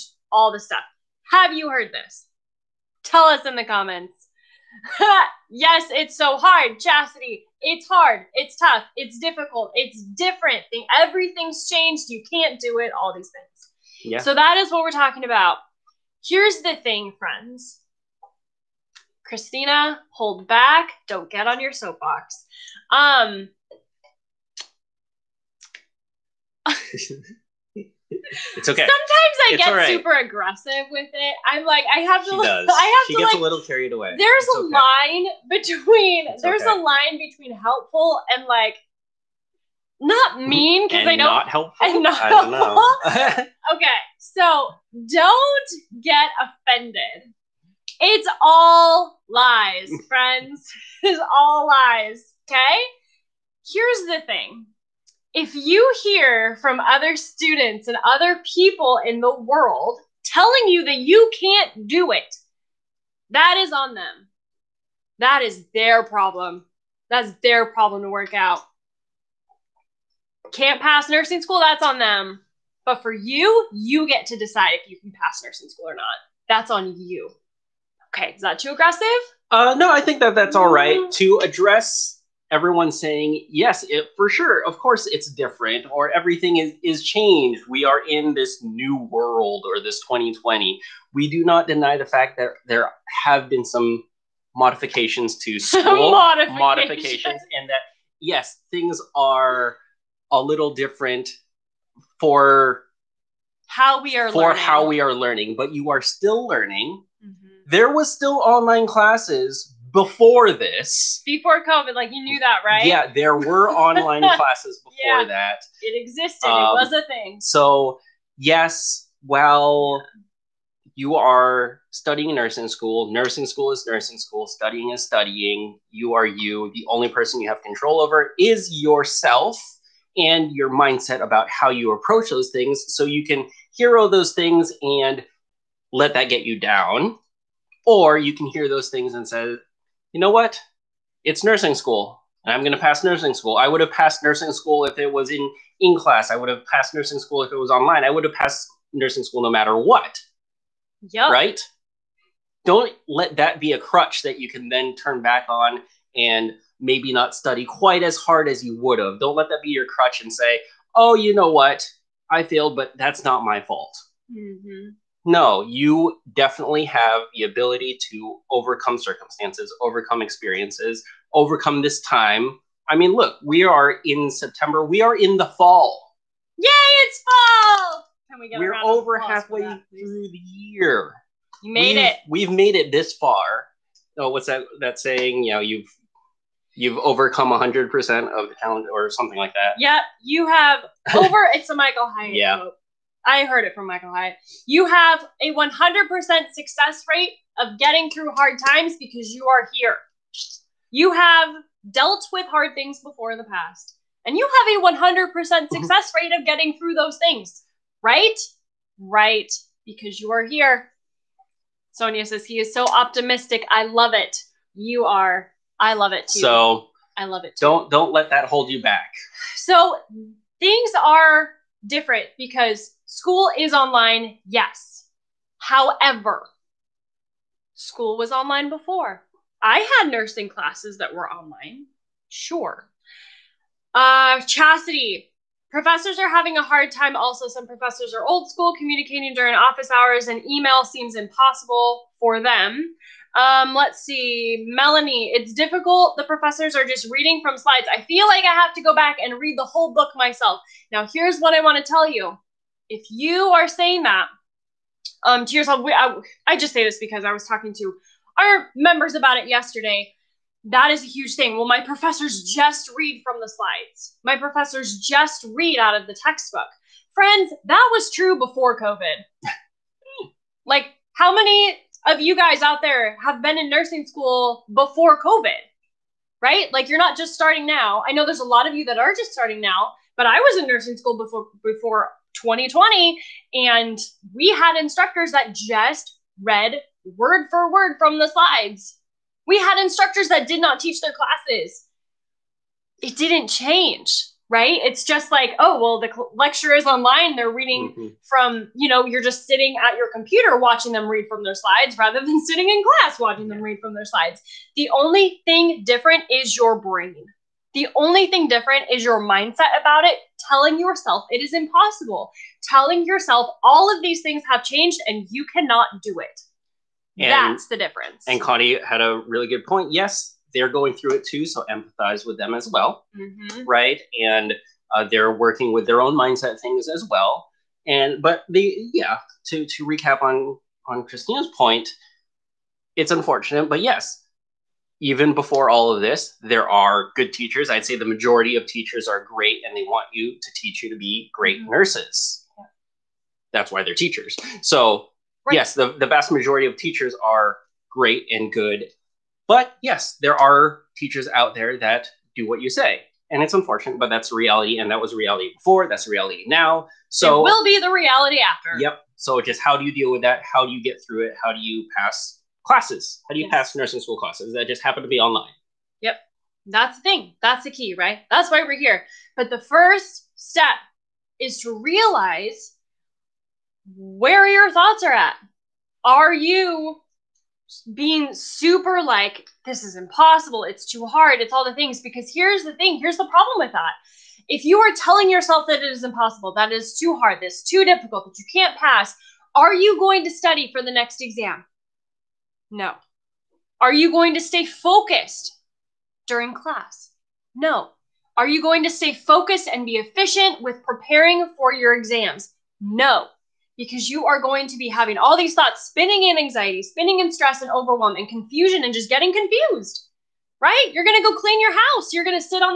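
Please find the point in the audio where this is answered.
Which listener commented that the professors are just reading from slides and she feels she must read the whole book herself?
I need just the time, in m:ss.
4:04.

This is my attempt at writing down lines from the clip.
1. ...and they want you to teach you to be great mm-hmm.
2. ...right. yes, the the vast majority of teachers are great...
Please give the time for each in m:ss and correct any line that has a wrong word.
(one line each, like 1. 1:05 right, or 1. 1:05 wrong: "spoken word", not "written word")
1. 5:39 right
2. 5:45 right.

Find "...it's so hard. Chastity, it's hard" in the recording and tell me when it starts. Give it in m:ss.
0:05.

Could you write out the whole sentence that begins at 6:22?
Because here's the thing, here's the problem with that.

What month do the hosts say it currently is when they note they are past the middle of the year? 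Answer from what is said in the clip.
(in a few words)
September.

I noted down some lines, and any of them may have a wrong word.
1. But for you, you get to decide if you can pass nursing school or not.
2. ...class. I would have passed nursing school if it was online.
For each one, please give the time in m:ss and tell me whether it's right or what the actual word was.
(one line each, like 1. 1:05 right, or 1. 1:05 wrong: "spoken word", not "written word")
1. 1:12 right
2. 2:25 right.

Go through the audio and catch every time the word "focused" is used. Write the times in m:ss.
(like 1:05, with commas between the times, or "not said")
6:34, 6:39.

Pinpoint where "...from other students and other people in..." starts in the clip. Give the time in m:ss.
0:56.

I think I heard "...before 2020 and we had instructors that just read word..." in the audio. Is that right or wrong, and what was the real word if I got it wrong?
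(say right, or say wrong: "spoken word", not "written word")
right.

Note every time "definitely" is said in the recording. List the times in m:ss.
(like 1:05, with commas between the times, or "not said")
2:46.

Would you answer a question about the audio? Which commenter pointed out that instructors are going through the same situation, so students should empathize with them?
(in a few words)
Connie.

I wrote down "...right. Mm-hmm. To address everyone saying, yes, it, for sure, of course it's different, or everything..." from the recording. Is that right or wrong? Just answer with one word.
right.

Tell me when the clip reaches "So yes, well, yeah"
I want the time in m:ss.
1:57.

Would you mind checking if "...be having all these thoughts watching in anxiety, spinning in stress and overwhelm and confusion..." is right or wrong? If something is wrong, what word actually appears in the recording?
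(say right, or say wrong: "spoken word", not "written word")
wrong: "spinning", not "watching".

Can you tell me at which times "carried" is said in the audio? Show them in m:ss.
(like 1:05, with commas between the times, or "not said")
0:33.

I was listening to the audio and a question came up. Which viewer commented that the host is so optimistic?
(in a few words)
Sonia.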